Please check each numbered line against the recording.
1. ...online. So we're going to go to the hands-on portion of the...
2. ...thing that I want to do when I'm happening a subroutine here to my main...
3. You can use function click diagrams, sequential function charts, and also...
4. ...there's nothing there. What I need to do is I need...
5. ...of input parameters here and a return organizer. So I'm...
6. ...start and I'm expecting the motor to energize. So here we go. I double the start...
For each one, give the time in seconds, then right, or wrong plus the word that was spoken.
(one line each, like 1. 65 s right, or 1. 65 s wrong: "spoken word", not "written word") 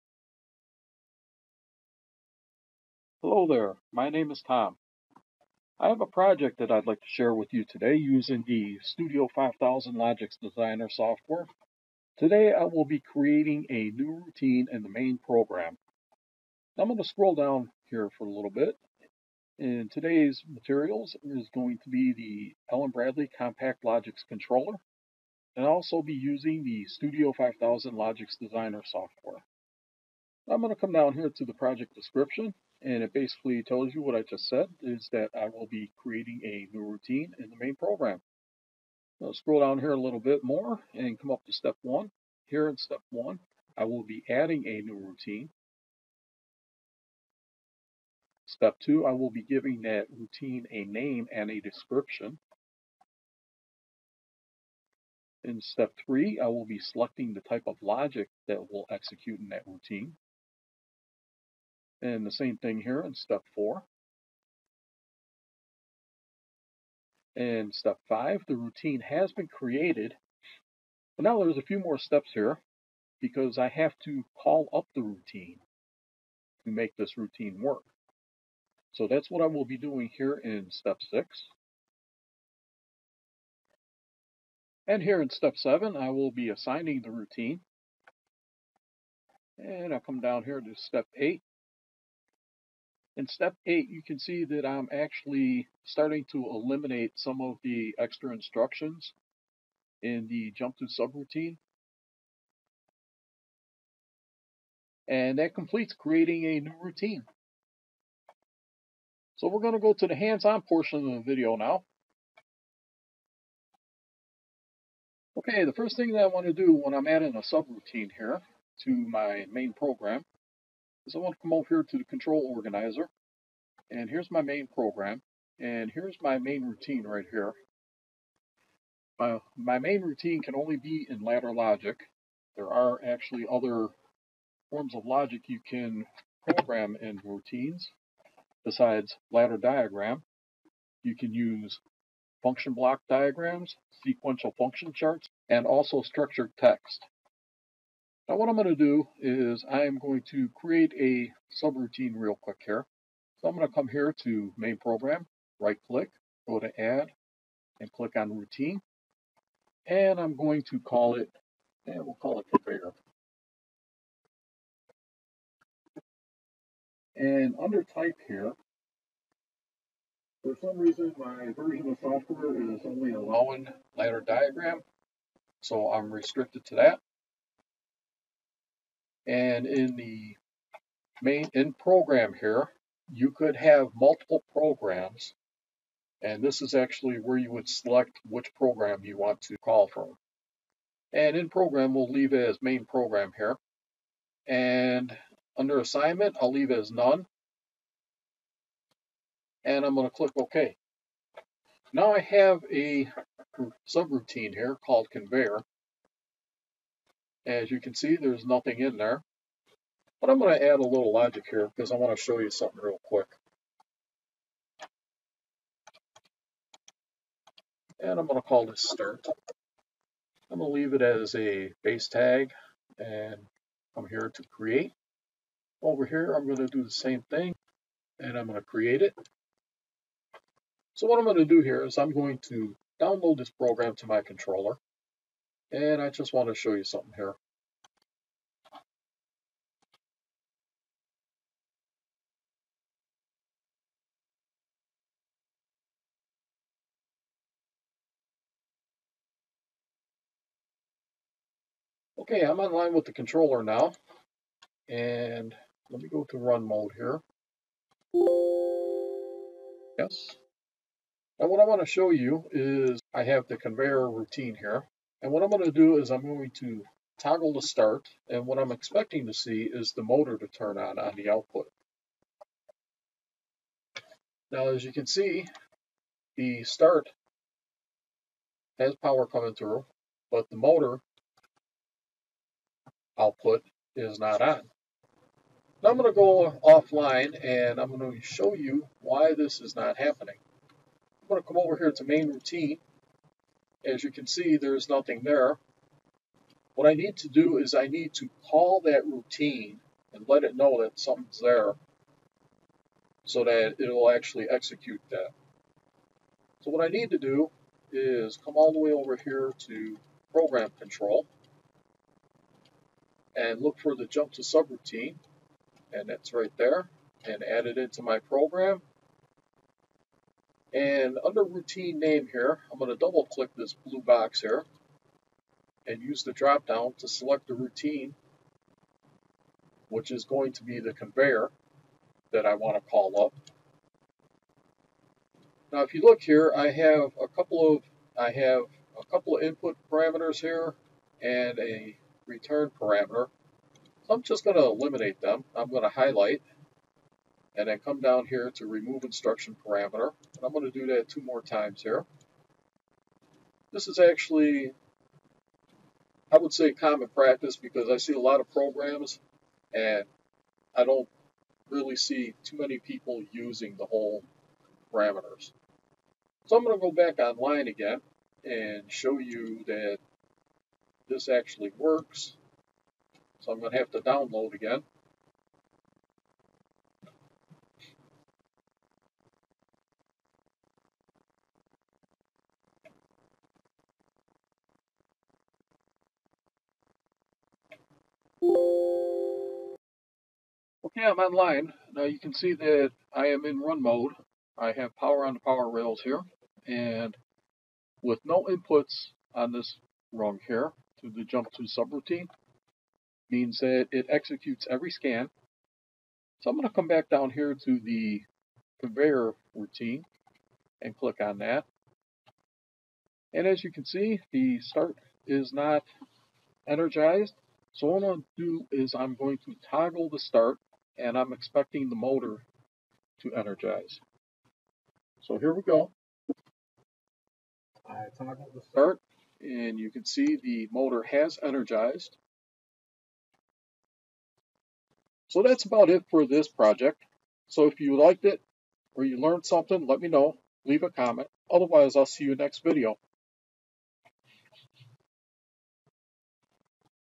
1. 106 s wrong: "routine", not "online"
2. 115 s wrong: "adding", not "happening"
3. 141 s wrong: "block", not "click"
4. 294 s right
5. 339 s wrong: "parameter", not "organizer"
6. 420 s wrong: "toggle", not "double".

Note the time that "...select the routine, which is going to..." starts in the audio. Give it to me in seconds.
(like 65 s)
327 s.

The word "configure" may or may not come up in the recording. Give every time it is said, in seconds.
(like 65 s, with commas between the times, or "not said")
162 s.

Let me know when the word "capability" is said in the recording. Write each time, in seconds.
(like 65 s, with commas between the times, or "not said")
not said.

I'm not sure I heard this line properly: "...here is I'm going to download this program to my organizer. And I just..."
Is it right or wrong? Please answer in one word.
wrong.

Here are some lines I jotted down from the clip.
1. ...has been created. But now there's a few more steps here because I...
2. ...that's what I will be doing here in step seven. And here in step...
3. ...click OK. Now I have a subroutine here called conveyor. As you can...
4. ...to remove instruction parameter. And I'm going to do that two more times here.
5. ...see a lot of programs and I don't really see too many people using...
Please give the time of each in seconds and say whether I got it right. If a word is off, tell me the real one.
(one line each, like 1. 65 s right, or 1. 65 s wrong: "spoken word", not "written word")
1. 69 s right
2. 79 s wrong: "six", not "seven"
3. 200 s right
4. 348 s right
5. 357 s right.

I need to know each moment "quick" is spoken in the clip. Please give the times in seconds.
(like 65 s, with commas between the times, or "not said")
152 s, 213 s.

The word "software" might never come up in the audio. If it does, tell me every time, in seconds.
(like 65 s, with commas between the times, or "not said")
10 s, 28 s, 172 s.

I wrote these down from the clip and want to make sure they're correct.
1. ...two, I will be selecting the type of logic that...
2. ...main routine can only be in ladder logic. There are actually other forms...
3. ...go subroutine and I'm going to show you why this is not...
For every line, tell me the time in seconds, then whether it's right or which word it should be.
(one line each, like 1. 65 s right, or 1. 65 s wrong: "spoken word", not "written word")
1. 56 s wrong: "three", not "two"
2. 129 s right
3. 286 s wrong: "offline", not "subroutine".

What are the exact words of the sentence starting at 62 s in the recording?
And the same thing here in step four.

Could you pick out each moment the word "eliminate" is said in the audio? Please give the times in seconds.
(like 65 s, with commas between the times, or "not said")
96 s, 344 s.